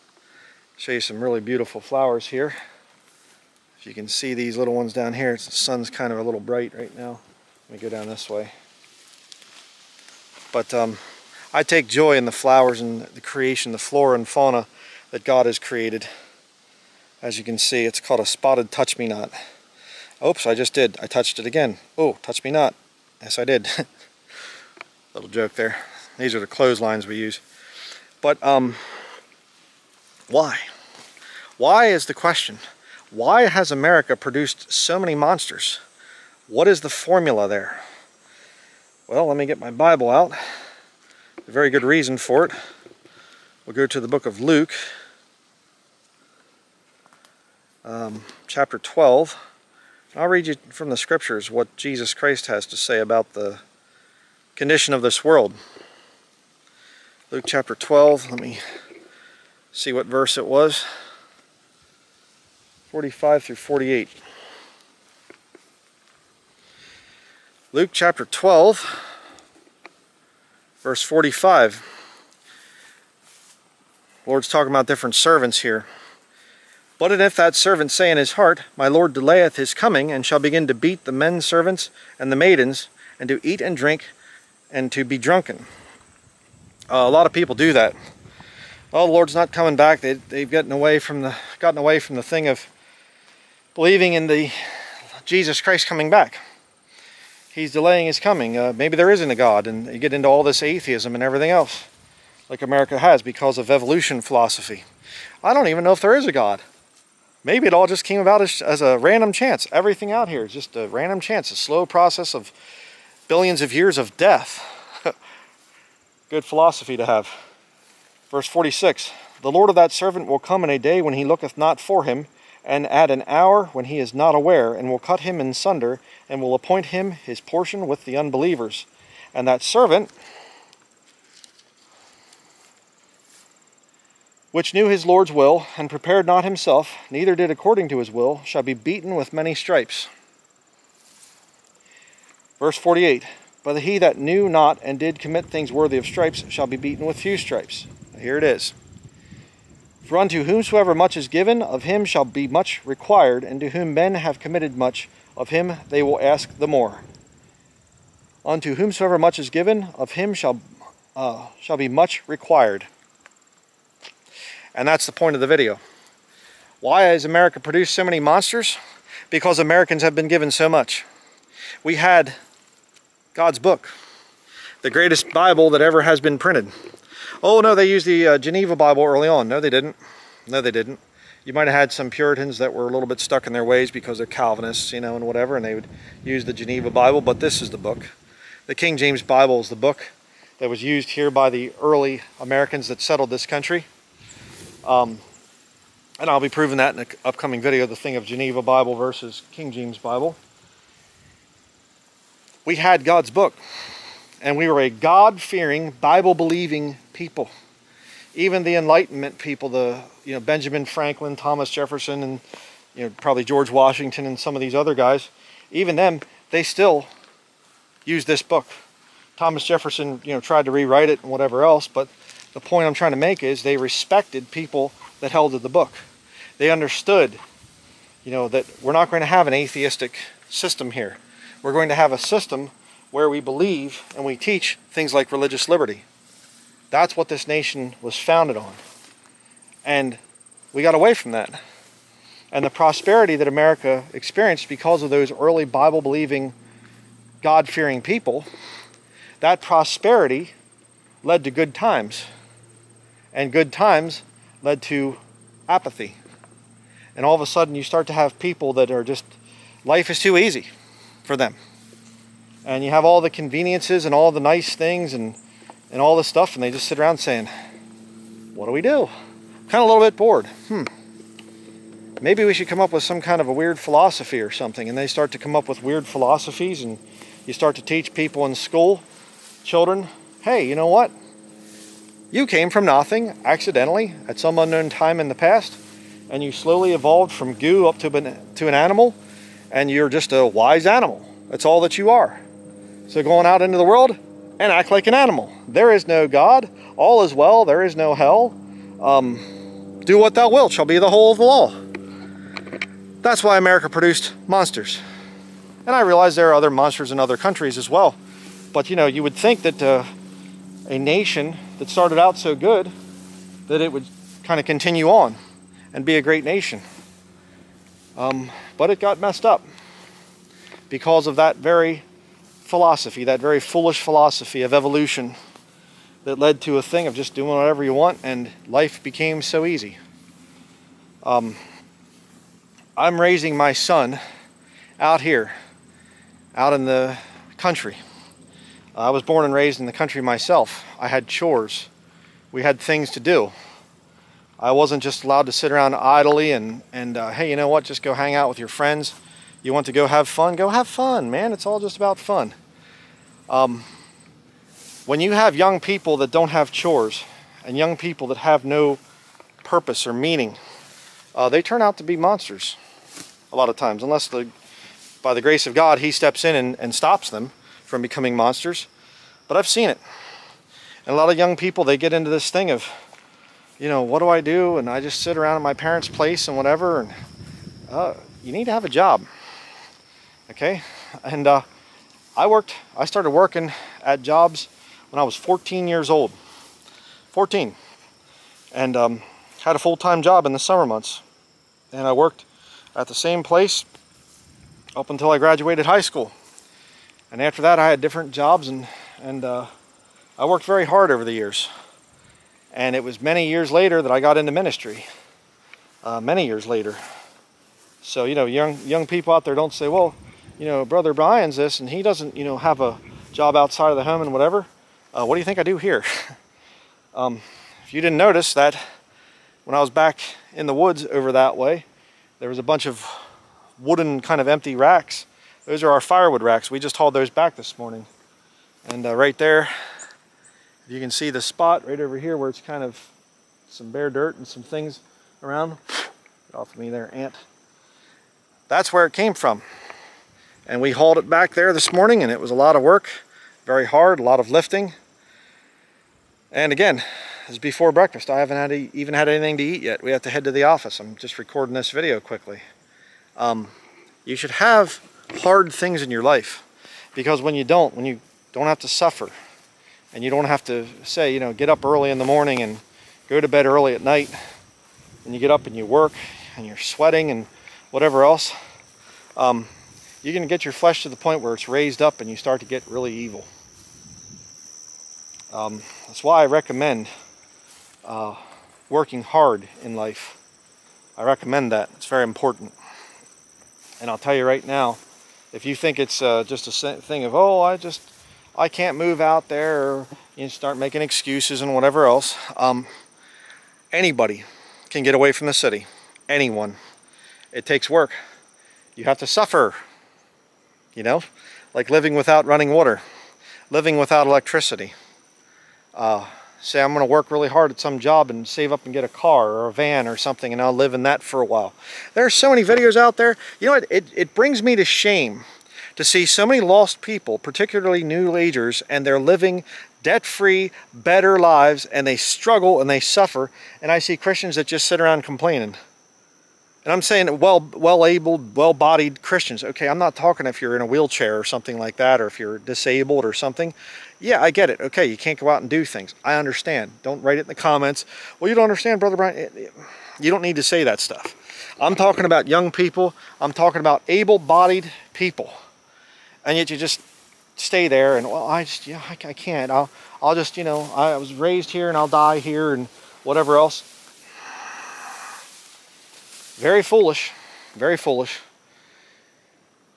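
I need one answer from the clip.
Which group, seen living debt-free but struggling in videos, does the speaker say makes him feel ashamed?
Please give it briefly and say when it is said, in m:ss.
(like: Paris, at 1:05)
new agers, at 8:38.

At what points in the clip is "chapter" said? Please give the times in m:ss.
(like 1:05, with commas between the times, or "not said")
0:48, 0:57, 1:07.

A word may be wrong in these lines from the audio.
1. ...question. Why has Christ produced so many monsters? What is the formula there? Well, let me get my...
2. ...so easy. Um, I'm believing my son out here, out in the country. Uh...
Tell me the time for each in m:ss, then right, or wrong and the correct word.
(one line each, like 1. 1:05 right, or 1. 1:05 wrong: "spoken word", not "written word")
1. 0:32 wrong: "America", not "Christ"
2. 5:29 wrong: "raising", not "believing".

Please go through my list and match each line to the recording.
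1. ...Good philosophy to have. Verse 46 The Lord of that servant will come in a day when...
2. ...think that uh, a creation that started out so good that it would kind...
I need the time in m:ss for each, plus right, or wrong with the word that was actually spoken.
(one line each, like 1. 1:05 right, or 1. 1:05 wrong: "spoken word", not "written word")
1. 1:56 right
2. 5:09 wrong: "nation", not "creation".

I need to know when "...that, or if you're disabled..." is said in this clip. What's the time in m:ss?
8:51.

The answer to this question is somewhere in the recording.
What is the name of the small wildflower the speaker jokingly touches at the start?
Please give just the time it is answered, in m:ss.
0:18.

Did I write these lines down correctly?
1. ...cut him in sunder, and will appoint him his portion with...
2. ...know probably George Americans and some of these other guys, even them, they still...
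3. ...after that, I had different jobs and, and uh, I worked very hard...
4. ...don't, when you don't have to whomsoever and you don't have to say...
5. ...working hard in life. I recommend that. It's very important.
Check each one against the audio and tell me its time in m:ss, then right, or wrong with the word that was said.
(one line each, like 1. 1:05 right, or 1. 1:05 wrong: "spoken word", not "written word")
1. 2:04 right
2. 3:33 wrong: "Washington", not "Americans"
3. 6:37 right
4. 7:37 wrong: "suffer", not "whomsoever"
5. 7:58 right.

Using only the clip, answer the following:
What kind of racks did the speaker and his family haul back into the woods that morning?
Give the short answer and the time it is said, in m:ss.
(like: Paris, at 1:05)
firewood racks, at 7:06.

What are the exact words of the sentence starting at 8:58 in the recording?
Well, you don't understand, Brother Bryan.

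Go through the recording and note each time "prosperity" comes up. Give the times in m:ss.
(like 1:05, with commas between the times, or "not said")
4:02, 4:09.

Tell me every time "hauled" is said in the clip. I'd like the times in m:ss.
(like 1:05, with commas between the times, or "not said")
7:06, 7:20.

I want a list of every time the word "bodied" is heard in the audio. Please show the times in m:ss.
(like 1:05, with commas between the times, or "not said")
8:48, 9:04.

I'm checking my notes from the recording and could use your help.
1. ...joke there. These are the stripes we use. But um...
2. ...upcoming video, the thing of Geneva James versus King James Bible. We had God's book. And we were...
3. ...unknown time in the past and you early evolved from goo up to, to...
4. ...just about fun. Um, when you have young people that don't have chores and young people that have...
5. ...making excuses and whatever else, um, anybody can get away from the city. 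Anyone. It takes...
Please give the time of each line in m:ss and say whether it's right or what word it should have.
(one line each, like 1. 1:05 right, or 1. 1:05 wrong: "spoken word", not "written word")
1. 0:25 wrong: "clotheslines", not "stripes"
2. 3:17 wrong: "Bible", not "James"
3. 4:44 wrong: "slowly", not "early"
4. 5:51 right
5. 8:10 right.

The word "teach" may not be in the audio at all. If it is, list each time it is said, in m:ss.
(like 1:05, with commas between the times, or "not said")
3:54, 4:37.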